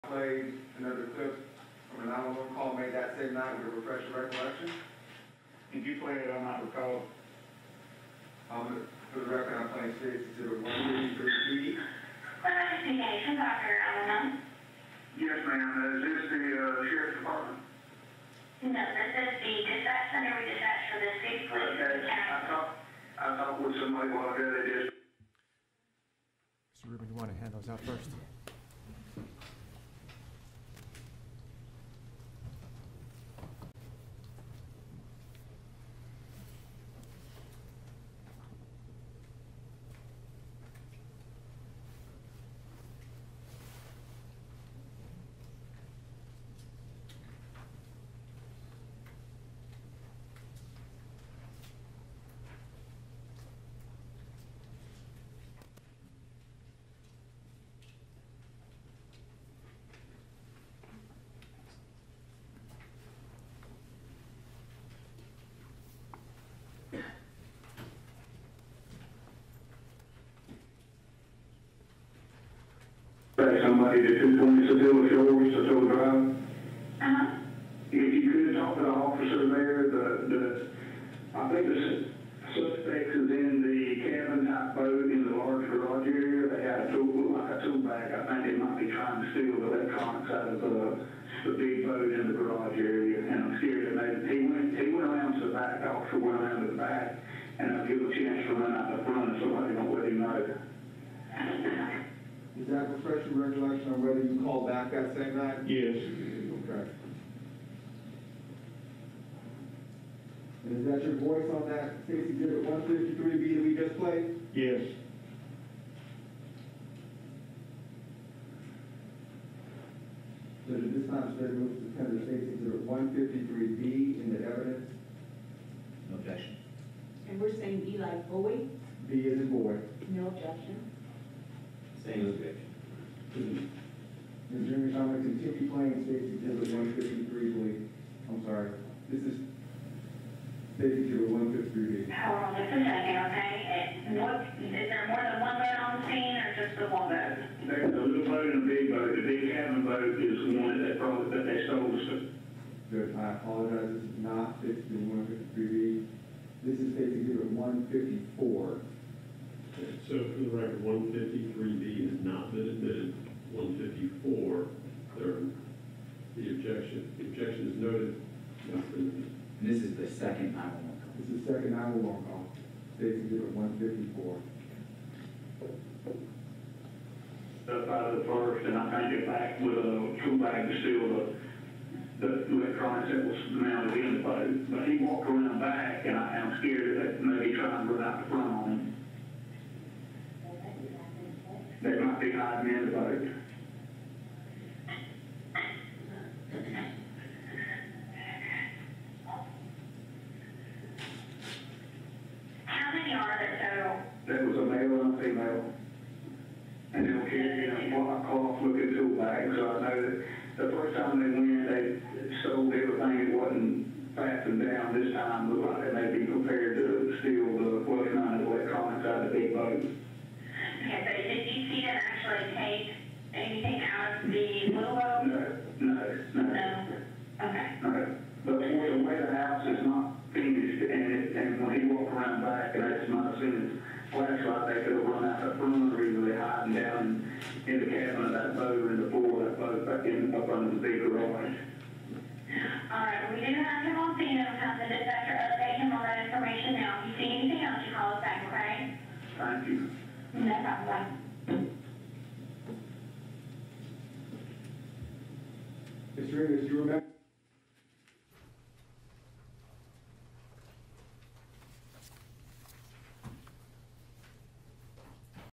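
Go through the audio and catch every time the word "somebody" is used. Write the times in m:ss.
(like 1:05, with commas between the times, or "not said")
0:23, 1:13.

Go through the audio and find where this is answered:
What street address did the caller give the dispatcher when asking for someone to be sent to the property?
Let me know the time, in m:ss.
1:14.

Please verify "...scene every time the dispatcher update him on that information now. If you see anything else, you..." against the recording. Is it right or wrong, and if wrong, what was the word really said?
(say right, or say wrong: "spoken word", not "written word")
right.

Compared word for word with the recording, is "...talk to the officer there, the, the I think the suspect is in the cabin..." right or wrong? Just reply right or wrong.
right.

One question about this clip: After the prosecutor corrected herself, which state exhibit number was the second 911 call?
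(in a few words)
154.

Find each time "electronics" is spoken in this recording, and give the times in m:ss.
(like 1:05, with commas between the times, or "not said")
1:29, 3:02.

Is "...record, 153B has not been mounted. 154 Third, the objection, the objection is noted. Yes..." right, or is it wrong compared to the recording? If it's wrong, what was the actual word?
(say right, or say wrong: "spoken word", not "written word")
wrong: "admitted", not "mounted".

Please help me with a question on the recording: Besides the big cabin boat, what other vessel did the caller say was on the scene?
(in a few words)
a little boat.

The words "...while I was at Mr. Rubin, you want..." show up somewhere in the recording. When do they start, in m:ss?
0:24.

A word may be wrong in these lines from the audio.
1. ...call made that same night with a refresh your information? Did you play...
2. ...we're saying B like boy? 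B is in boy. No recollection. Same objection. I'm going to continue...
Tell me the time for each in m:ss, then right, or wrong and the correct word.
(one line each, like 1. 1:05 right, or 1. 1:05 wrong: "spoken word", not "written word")
1. 0:02 wrong: "recollection", not "information"
2. 2:07 wrong: "objection", not "recollection".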